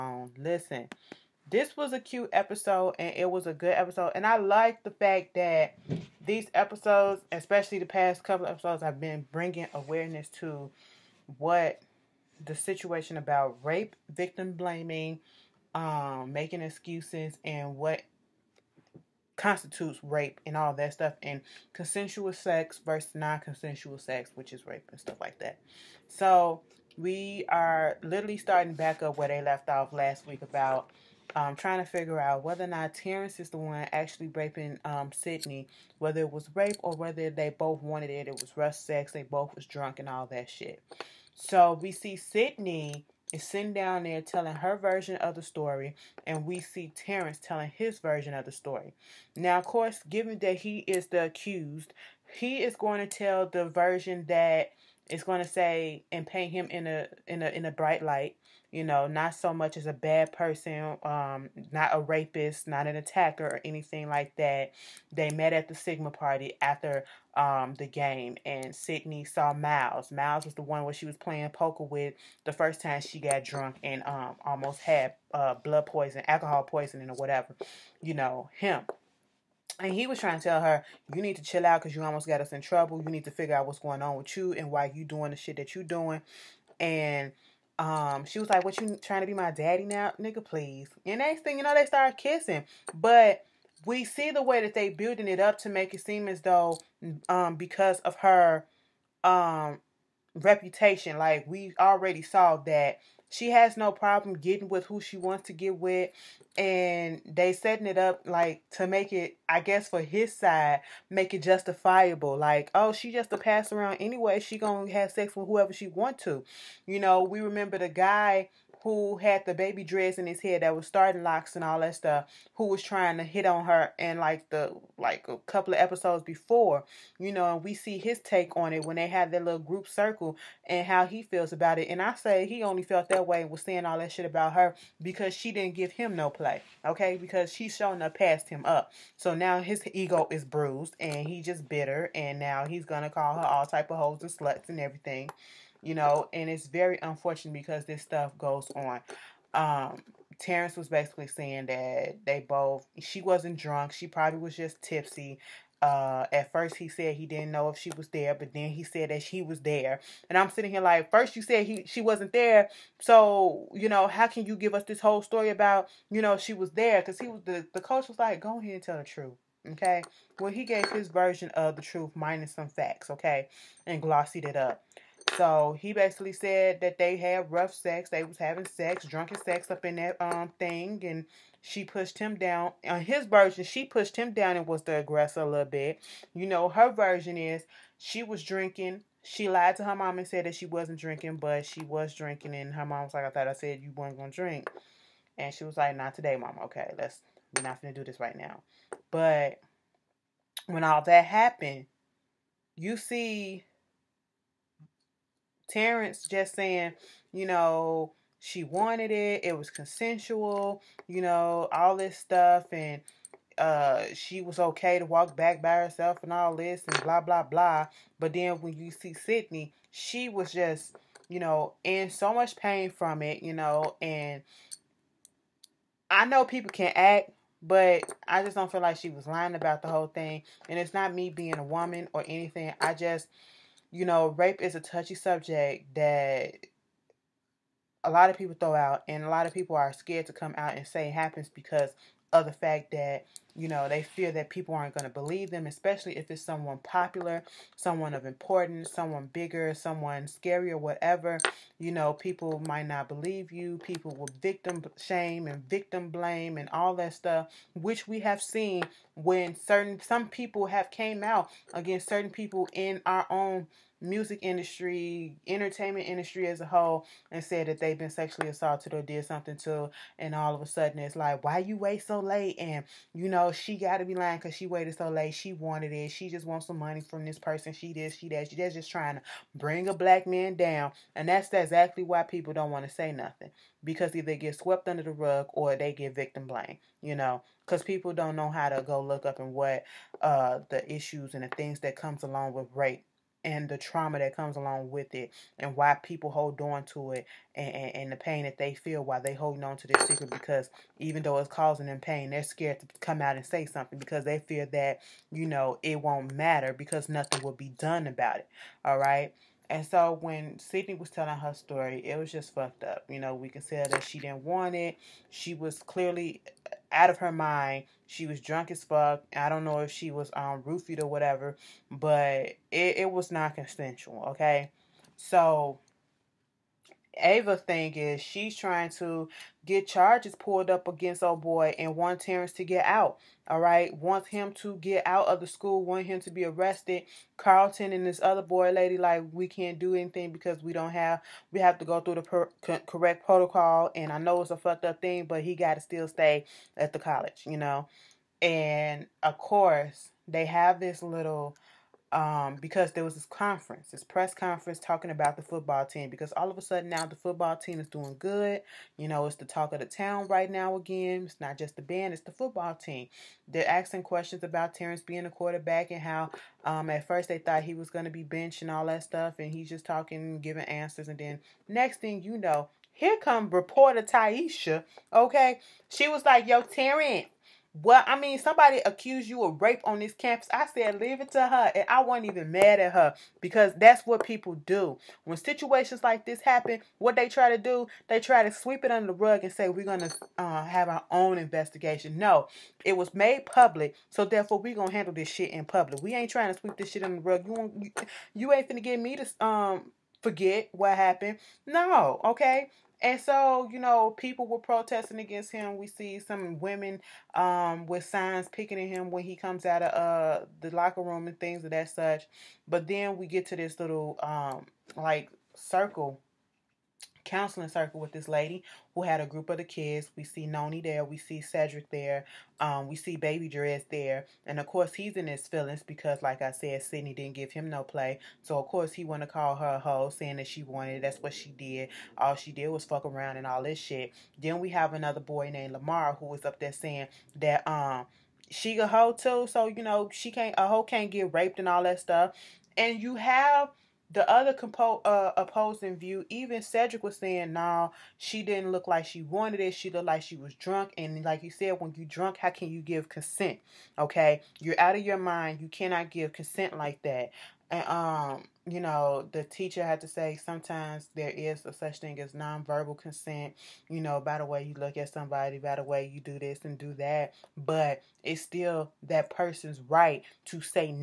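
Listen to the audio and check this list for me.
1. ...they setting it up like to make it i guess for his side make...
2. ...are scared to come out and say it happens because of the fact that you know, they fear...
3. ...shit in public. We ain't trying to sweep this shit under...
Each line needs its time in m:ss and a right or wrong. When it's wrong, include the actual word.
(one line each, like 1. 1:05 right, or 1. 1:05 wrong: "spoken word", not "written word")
1. 1:47 right
2. 3:59 right
3. 6:35 right.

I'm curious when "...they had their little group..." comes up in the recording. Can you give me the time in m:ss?
2:08.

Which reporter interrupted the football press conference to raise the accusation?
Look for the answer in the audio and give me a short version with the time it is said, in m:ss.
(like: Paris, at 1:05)
Taisha, at 6:13.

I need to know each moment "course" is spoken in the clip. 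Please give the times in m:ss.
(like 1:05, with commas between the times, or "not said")
0:49, 5:49, 7:04, 7:08.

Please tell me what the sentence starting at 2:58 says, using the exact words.
They was having sex, drunken sex up in that um thing, and she pushed him down.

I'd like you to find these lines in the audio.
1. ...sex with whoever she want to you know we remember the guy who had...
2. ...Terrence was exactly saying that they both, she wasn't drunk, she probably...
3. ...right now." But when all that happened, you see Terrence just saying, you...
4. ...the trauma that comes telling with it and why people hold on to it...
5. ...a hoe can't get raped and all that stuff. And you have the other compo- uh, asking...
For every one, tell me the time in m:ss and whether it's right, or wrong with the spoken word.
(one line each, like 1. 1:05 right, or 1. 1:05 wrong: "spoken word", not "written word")
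1. 1:55 right
2. 2:30 wrong: "basically", not "exactly"
3. 3:18 right
4. 4:53 wrong: "along", not "telling"
5. 7:20 wrong: "opposing", not "asking".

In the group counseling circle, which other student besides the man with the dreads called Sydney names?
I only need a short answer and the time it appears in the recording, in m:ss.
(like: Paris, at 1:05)
Lamar, at 7:15.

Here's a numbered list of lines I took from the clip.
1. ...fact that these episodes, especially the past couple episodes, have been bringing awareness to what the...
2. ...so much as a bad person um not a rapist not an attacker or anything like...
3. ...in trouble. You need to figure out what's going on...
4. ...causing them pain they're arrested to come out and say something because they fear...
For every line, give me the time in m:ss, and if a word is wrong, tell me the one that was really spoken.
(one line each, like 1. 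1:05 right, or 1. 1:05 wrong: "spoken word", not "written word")
1. 0:04 right
2. 0:59 right
3. 1:22 right
4. 5:01 wrong: "scared", not "arrested".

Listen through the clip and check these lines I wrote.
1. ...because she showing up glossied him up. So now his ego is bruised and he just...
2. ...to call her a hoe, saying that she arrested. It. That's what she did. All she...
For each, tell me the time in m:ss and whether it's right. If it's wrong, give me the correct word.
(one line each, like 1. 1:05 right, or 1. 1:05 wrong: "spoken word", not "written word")
1. 2:17 wrong: "passed", not "glossied"
2. 7:09 wrong: "wanted", not "arrested".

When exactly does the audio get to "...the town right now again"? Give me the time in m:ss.
5:59.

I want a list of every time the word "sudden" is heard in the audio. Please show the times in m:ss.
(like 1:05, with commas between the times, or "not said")
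4:30, 5:56.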